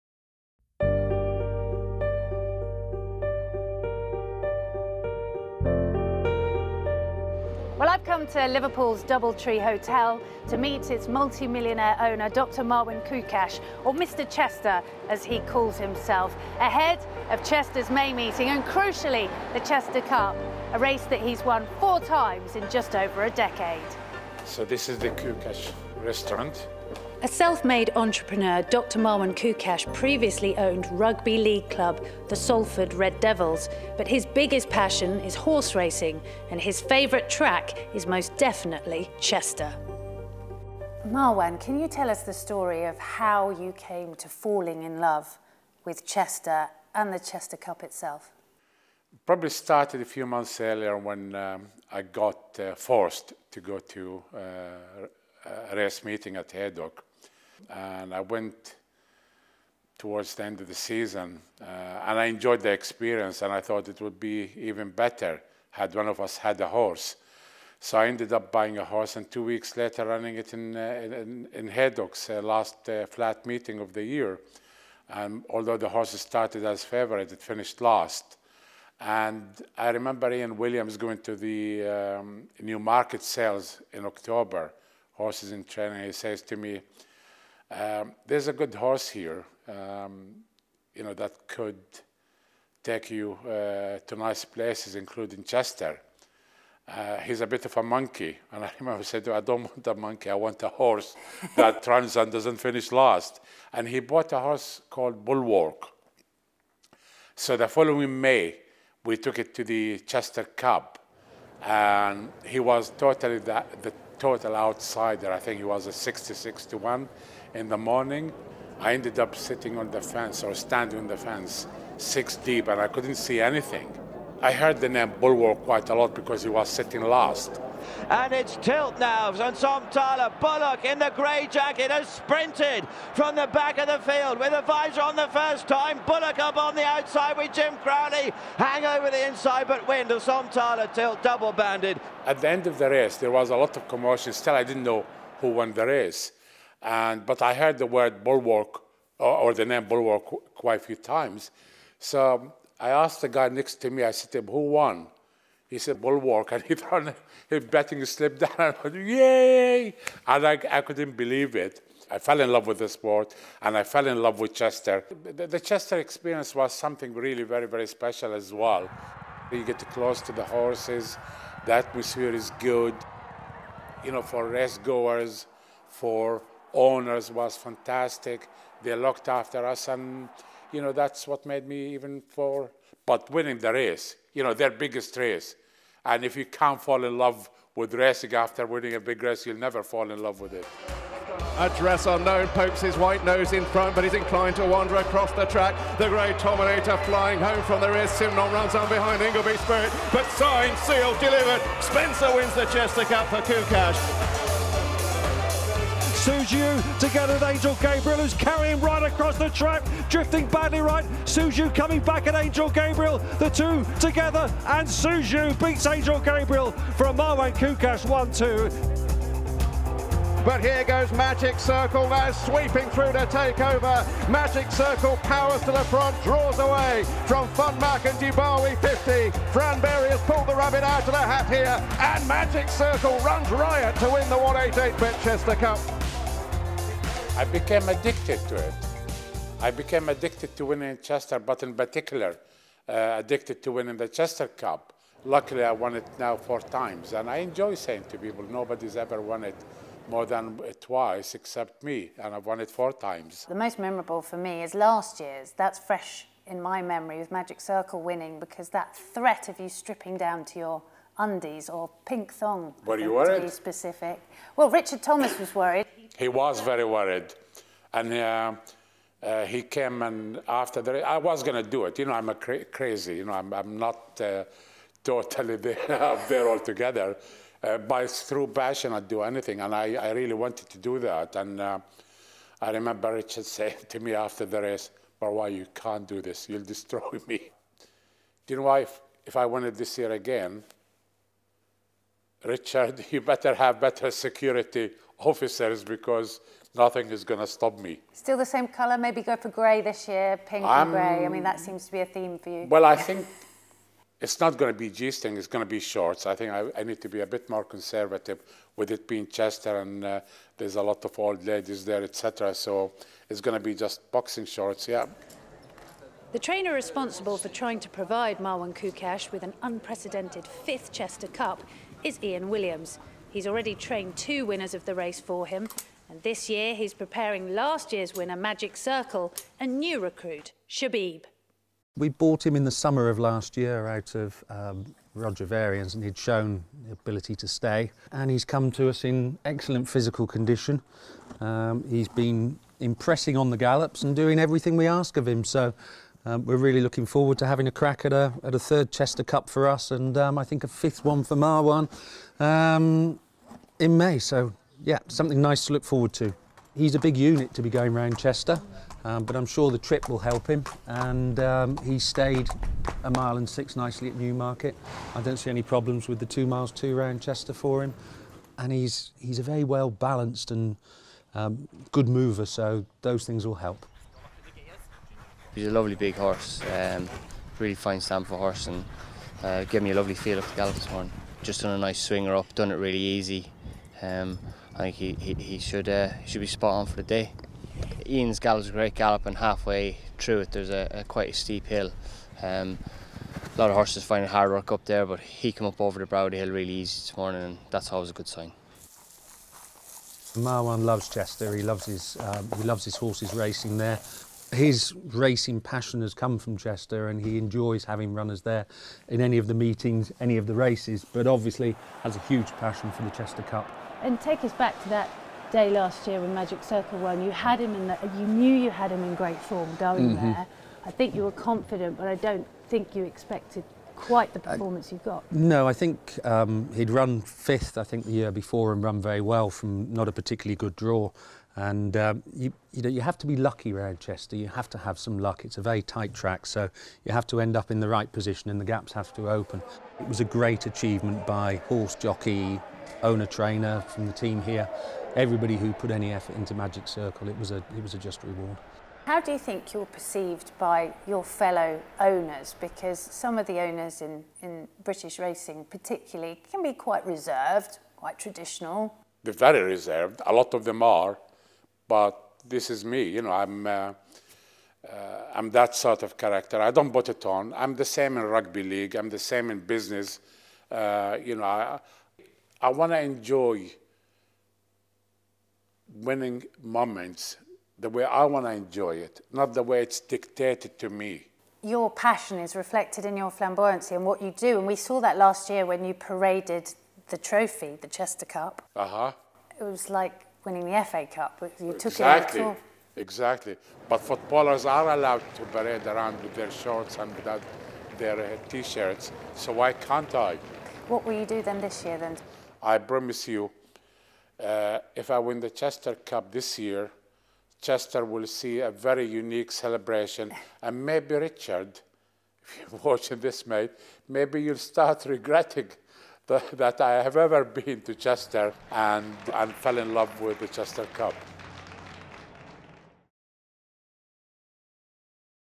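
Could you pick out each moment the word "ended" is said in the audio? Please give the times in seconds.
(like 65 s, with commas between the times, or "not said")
68 s, 118 s.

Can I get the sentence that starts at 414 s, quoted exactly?
And take us back to that day last year when Magic Circle won.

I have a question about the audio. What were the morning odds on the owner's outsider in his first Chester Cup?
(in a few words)
66 to 1.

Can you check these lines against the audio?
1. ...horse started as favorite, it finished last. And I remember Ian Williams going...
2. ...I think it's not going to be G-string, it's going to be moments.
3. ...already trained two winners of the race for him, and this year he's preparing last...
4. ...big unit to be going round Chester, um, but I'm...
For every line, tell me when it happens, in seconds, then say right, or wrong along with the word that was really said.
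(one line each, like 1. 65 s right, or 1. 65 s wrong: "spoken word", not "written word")
1. 75 s right
2. 302 s wrong: "shorts", not "moments"
3. 323 s right
4. 356 s right.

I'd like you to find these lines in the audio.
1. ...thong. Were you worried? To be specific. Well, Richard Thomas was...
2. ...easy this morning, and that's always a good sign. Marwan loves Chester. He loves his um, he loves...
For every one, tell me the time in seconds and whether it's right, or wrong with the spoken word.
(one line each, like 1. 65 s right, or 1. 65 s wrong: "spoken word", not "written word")
1. 262 s right
2. 396 s right.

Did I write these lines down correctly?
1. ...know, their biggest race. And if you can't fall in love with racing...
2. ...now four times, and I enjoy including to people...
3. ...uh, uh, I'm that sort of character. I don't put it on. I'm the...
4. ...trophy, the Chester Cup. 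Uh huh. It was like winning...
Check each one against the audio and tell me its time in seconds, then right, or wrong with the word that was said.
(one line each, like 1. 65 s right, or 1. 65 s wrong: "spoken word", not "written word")
1. 184 s right
2. 246 s wrong: "saying", not "including"
3. 463 s right
4. 487 s right.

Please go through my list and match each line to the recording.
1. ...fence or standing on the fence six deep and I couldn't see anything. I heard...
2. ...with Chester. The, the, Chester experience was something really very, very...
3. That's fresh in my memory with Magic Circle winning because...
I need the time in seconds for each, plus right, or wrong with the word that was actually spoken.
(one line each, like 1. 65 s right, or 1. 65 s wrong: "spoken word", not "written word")
1. 119 s right
2. 164 s right
3. 255 s right.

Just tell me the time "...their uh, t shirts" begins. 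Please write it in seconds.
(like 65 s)
497 s.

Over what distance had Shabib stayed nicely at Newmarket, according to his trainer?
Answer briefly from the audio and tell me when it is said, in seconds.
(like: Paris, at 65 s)
a mile and six, at 363 s.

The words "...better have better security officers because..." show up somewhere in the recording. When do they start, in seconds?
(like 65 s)
293 s.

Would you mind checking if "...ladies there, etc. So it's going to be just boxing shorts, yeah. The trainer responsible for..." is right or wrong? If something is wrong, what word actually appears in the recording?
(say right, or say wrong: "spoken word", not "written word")
right.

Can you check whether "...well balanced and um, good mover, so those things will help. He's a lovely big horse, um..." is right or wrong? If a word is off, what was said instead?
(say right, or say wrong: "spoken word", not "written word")
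right.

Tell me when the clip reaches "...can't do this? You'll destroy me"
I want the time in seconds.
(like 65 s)
285 s.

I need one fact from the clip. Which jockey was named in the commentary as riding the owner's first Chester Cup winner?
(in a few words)
Jim Crowley.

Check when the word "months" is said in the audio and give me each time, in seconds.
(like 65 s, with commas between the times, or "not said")
50 s.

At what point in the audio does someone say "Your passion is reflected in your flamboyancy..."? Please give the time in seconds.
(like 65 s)
481 s.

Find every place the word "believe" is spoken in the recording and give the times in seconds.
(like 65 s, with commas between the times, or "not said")
161 s.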